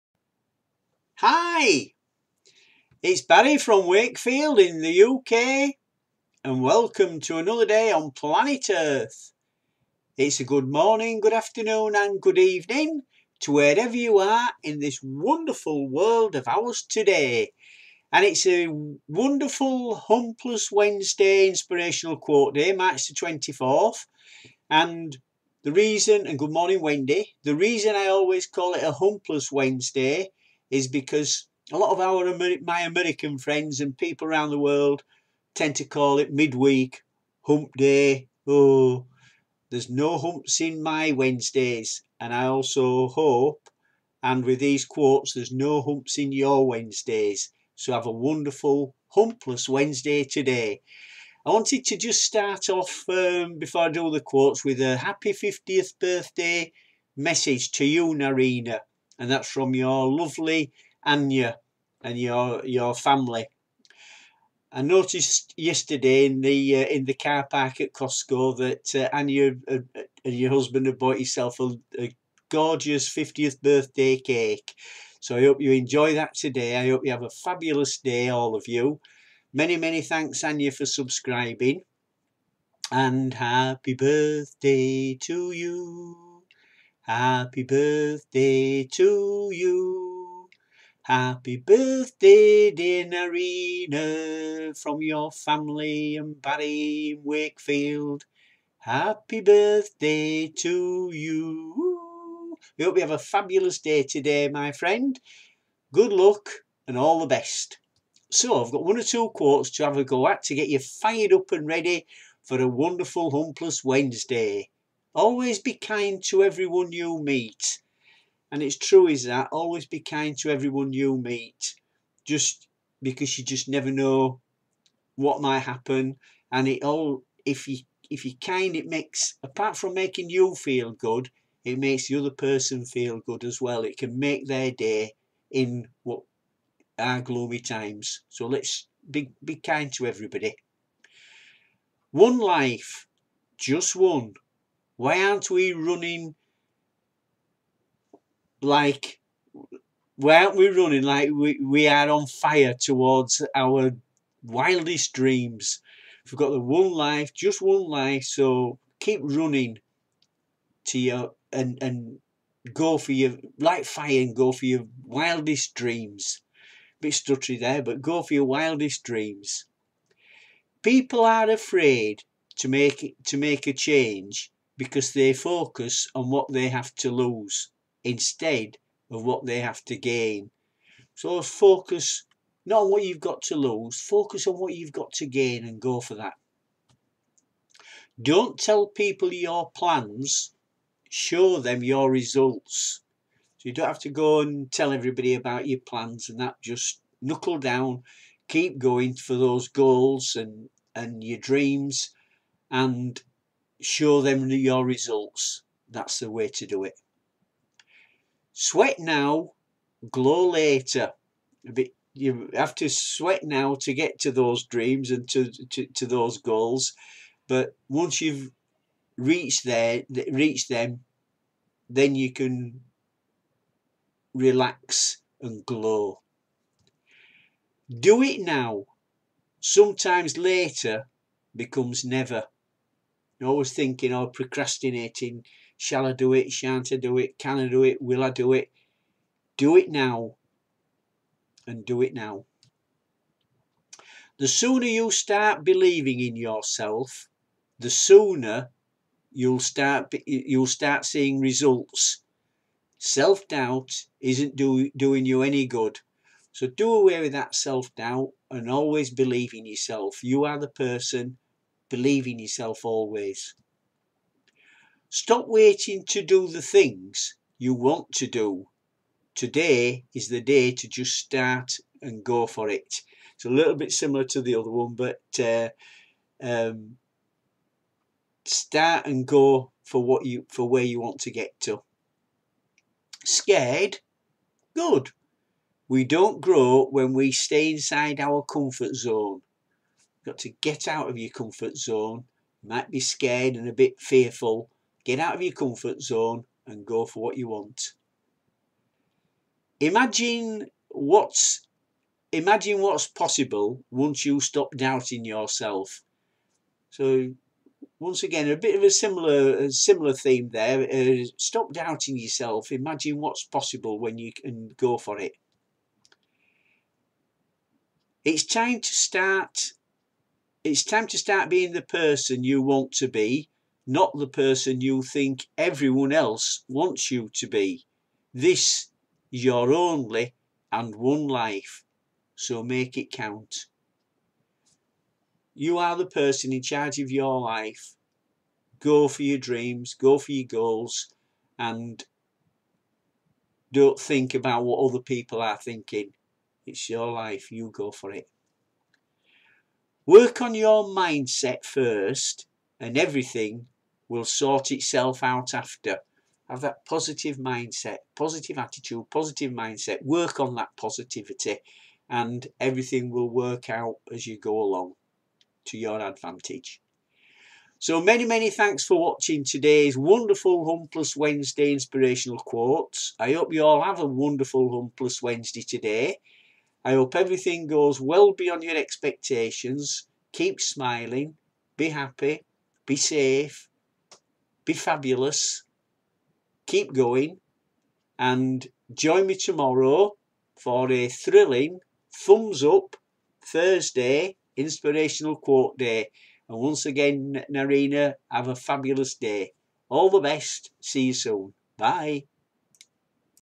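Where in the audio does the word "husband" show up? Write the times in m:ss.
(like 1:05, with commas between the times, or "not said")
1:10.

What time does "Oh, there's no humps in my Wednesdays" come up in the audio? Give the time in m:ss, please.
0:38.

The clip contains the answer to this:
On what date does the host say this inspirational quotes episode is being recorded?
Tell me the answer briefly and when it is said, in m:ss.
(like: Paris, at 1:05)
March 24th, at 0:22.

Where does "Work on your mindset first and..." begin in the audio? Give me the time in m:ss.
5:50.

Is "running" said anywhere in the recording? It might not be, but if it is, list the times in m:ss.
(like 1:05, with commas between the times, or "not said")
2:25, 2:30, 2:39.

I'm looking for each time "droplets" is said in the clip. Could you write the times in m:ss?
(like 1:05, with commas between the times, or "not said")
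not said.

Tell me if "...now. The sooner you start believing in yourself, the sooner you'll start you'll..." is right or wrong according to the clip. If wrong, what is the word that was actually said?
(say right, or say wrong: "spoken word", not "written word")
right.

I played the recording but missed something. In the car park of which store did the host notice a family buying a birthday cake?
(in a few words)
Costco.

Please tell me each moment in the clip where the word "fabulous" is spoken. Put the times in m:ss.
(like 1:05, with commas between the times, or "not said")
1:17, 1:43, 6:24, 6:38.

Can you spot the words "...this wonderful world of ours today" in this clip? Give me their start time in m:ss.
0:14.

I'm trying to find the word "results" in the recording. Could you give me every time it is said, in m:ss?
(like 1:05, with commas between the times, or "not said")
3:12, 3:24, 4:11.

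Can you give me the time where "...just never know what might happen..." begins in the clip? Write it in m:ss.
2:03.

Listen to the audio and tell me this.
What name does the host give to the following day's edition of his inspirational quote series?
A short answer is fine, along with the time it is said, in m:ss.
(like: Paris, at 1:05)
Thumbs Up Thursday, at 6:32.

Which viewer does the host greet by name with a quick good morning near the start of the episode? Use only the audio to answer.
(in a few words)
Wendy.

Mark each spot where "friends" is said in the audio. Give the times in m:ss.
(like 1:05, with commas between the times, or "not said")
0:33, 1:44.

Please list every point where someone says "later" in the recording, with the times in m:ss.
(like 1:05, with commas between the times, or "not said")
3:30, 3:50.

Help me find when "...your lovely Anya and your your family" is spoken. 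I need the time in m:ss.
0:59.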